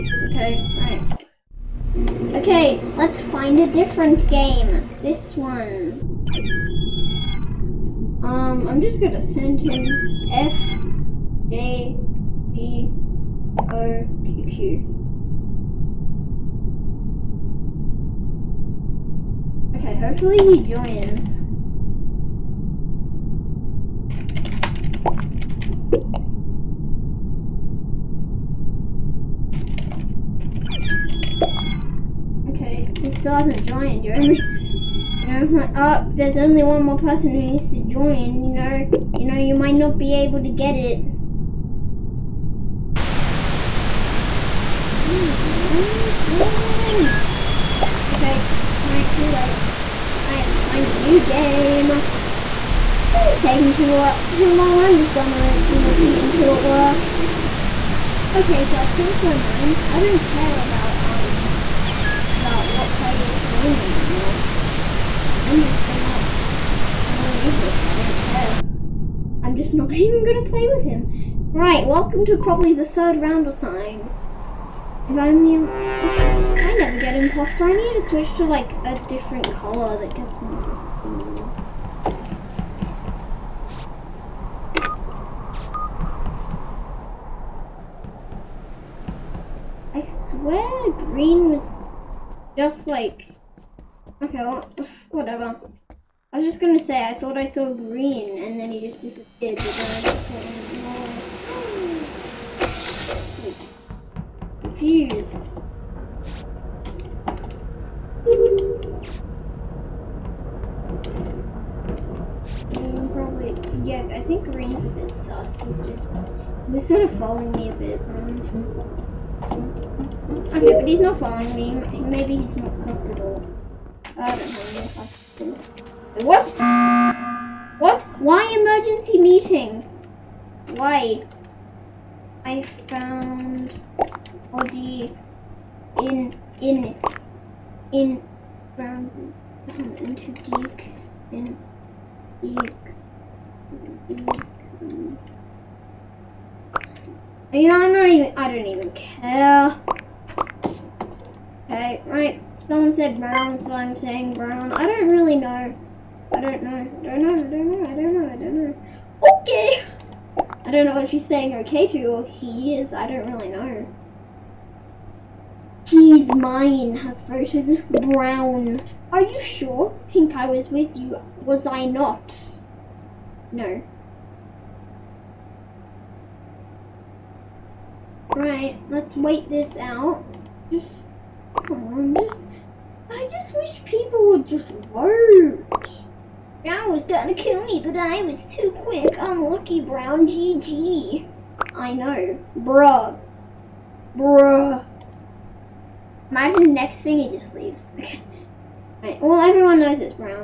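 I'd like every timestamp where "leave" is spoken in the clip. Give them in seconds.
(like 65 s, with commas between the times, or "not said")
67 s, 197 s.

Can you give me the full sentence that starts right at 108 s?
Mm, probably, yeah, I think green's a bit sus, he's just, he's sort of following me a bit.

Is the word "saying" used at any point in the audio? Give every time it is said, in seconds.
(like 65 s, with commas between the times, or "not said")
153 s, 161 s.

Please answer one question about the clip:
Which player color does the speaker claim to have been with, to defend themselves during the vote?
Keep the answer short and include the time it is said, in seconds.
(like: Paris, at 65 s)
Pink, at 170 s.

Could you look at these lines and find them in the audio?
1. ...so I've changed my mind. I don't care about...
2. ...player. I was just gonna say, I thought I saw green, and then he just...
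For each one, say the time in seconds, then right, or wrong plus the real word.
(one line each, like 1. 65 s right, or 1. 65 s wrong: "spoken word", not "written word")
1. 58 s right
2. 95 s wrong: "whatever", not "player".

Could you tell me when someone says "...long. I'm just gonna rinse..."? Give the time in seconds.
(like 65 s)
54 s.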